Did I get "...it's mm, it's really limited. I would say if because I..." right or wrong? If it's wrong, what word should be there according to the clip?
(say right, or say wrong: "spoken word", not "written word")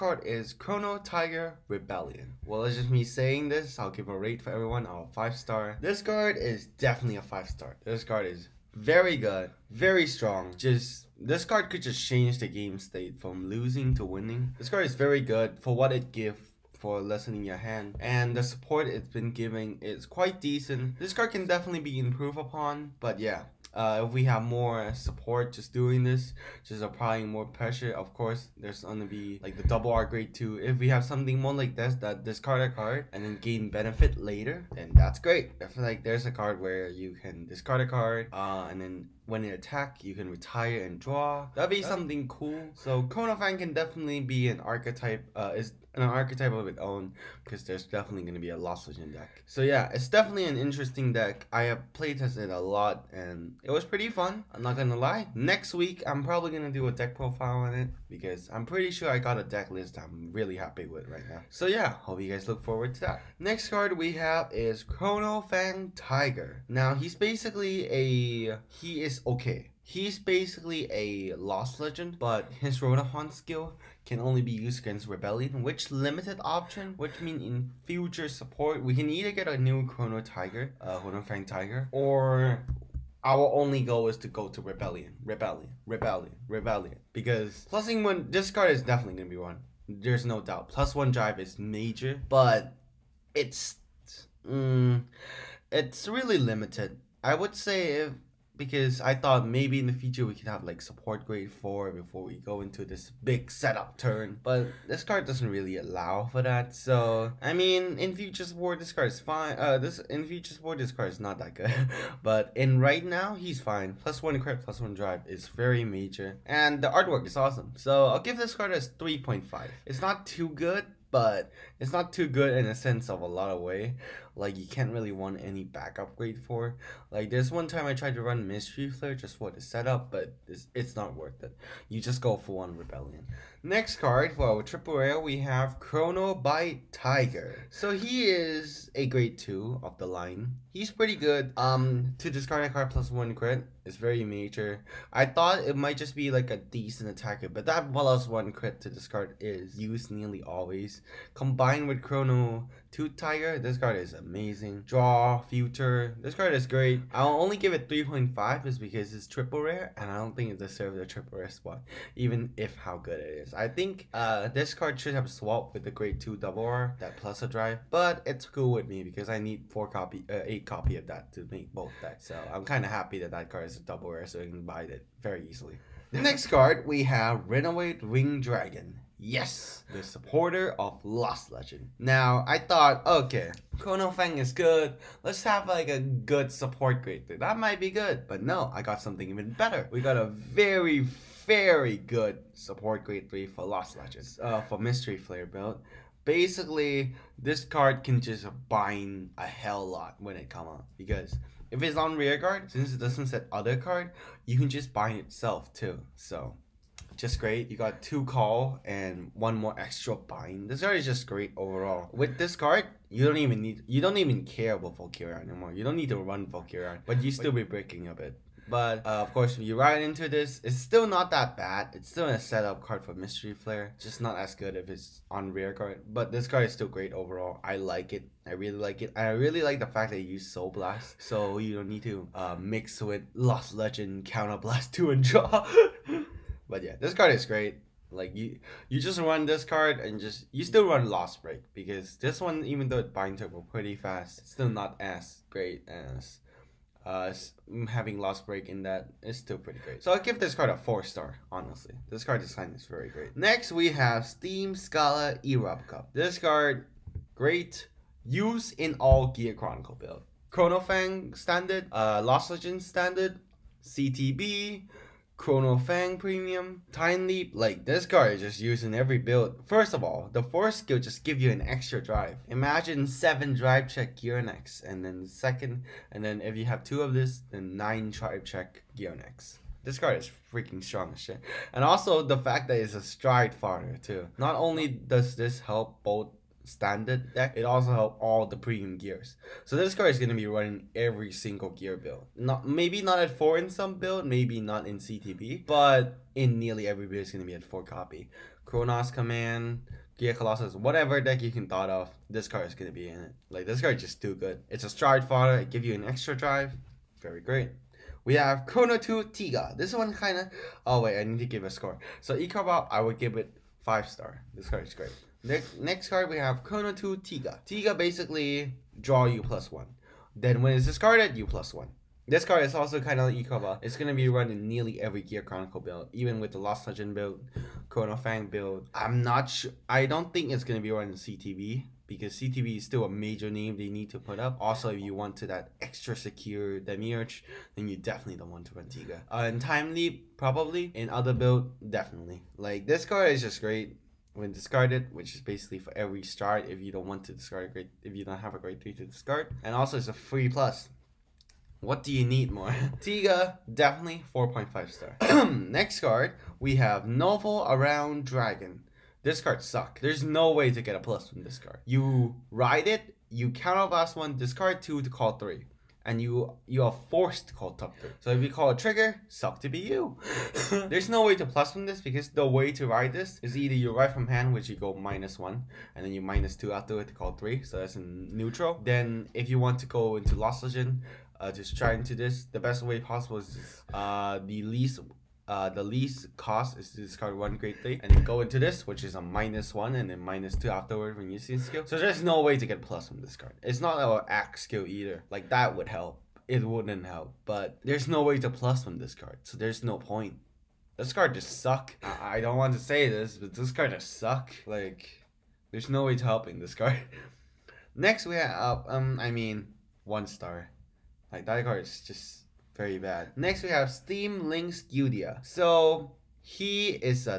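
right.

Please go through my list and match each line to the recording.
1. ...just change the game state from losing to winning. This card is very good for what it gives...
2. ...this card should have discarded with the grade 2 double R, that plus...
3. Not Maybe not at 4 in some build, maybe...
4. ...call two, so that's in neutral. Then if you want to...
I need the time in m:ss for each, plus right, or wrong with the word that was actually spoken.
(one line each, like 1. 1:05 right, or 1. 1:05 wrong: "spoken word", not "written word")
1. 0:11 right
2. 2:44 wrong: "swapped", not "discarded"
3. 4:52 right
4. 6:17 wrong: "three", not "two".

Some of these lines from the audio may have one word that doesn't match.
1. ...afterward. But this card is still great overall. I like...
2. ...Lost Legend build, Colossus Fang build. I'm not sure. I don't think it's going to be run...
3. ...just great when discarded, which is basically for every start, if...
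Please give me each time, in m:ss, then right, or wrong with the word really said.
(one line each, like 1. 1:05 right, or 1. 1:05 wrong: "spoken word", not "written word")
1. 3:45 wrong: "guard", not "afterward"
2. 5:26 wrong: "Chrono", not "Colossus"
3. 5:43 right.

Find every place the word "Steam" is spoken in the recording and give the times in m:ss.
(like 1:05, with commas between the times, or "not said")
4:14, 6:53.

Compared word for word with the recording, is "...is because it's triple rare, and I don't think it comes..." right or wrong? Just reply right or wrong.
wrong.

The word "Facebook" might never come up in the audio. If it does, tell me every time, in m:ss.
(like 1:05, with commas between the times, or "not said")
not said.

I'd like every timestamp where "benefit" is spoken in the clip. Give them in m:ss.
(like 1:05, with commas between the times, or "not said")
0:33.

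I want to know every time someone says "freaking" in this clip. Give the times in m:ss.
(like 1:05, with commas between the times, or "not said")
4:40.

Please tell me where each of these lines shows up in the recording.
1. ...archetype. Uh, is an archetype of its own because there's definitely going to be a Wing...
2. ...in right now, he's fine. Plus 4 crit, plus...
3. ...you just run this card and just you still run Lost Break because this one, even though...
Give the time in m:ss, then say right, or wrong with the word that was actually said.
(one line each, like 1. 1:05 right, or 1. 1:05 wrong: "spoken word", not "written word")
1. 0:44 wrong: "Lost", not "Wing"
2. 1:52 wrong: "1", not "4"
3. 3:58 right.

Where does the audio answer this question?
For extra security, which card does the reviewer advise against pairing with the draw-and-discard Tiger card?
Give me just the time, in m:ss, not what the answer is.
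5:36.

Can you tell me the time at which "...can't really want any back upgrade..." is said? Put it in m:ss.
2:04.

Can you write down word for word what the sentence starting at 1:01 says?
So yeah, hope you guys look forward to that.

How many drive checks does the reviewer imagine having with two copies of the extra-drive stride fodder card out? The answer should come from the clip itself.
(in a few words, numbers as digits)
9.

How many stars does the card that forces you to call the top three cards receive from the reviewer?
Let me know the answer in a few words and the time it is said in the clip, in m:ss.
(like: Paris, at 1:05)
1, at 6:50.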